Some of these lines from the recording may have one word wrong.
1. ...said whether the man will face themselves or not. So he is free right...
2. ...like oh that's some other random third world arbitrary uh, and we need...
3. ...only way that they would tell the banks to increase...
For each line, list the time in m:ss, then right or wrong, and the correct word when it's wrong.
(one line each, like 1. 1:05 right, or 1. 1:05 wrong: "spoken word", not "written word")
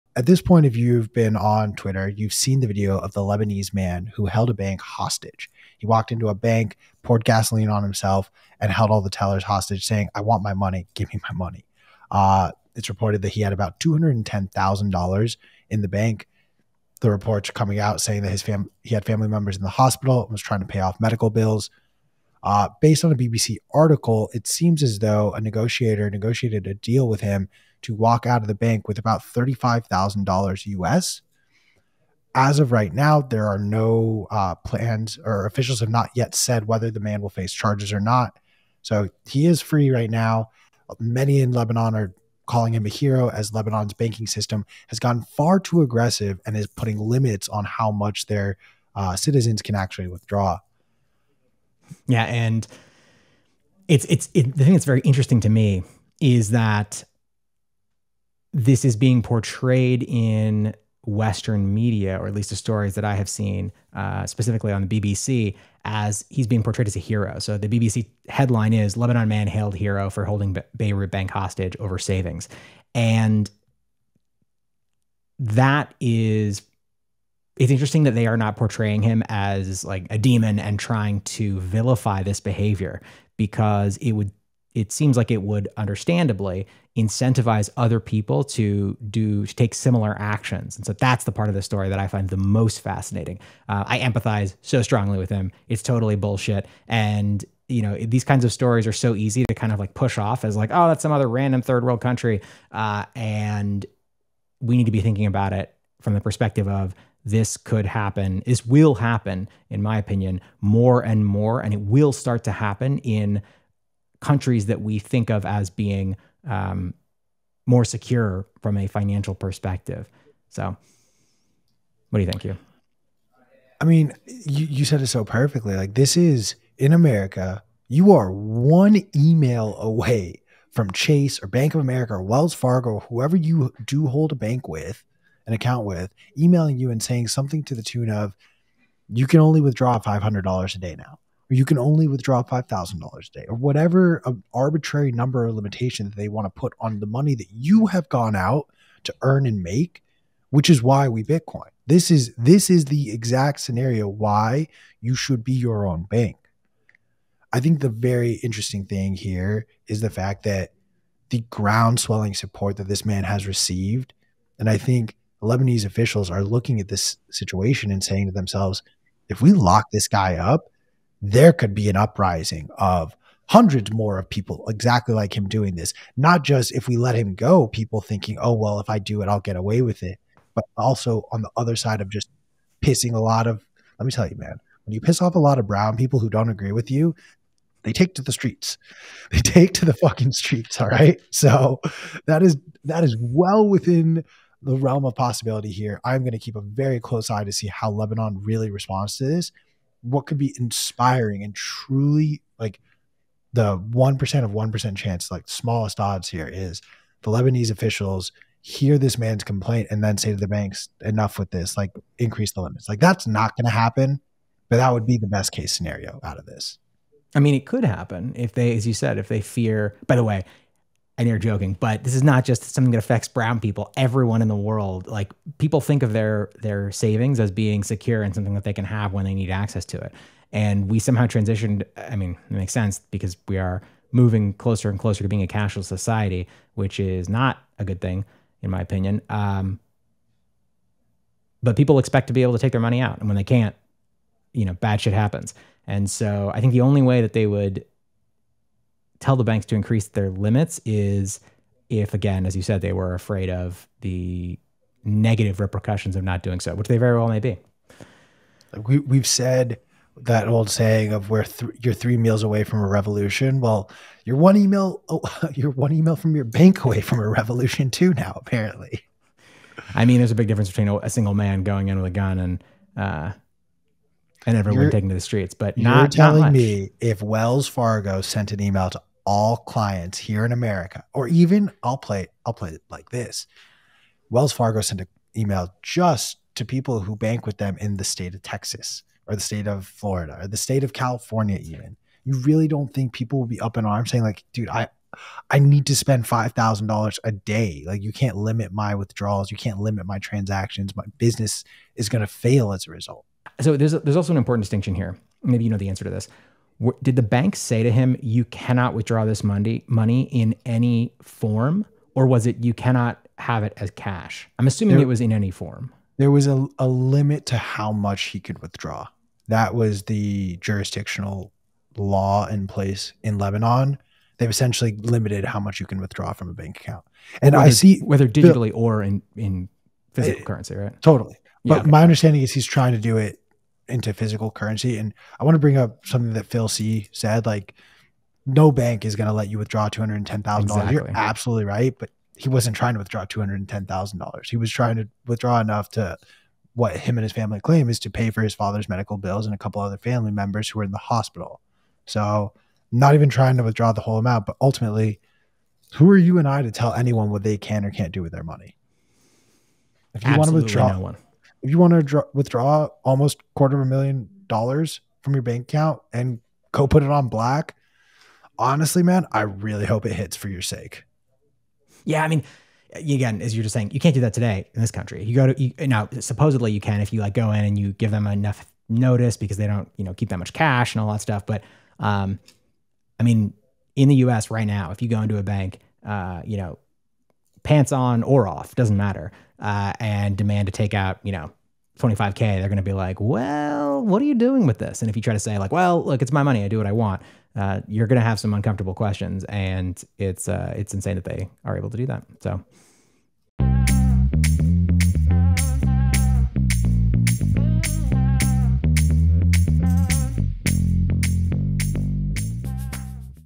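1. 0:36 wrong: "charges", not "themselves"
2. 1:40 wrong: "country", not "arbitrary"
3. 4:06 right.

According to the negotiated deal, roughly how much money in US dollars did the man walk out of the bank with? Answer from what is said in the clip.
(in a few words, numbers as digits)
$35,000.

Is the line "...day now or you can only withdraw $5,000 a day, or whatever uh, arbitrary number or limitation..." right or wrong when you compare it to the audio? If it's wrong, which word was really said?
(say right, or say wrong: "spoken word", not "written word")
right.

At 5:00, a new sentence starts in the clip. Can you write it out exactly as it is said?
My business is going to fail as a result.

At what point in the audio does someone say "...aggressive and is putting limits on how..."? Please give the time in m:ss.
0:45.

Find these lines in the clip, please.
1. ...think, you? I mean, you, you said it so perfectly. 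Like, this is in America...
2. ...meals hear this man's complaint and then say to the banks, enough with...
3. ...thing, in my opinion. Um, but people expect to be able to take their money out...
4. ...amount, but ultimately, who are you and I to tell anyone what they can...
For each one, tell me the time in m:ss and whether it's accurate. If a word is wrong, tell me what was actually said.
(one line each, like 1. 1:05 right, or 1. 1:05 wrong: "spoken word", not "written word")
1. 2:02 right
2. 3:27 wrong: "officials", not "meals"
3. 3:58 right
4. 5:54 right.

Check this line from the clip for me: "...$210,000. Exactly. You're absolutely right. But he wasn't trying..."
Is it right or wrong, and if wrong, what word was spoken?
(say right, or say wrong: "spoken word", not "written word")
right.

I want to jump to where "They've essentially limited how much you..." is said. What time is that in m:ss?
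5:24.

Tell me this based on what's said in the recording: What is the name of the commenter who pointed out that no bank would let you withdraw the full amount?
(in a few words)
Phil C.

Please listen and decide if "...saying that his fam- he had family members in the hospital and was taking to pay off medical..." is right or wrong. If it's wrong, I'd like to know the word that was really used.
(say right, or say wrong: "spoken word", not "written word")
wrong: "trying", not "taking".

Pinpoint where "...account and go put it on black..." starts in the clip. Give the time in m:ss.
6:05.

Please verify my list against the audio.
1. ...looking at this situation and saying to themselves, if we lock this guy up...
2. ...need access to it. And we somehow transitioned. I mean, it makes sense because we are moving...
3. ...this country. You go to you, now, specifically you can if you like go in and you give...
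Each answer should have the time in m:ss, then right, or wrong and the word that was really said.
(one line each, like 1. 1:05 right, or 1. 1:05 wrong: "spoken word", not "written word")
1. 2:46 right
2. 3:49 right
3. 6:14 wrong: "supposedly", not "specifically".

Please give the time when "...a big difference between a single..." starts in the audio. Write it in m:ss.
4:30.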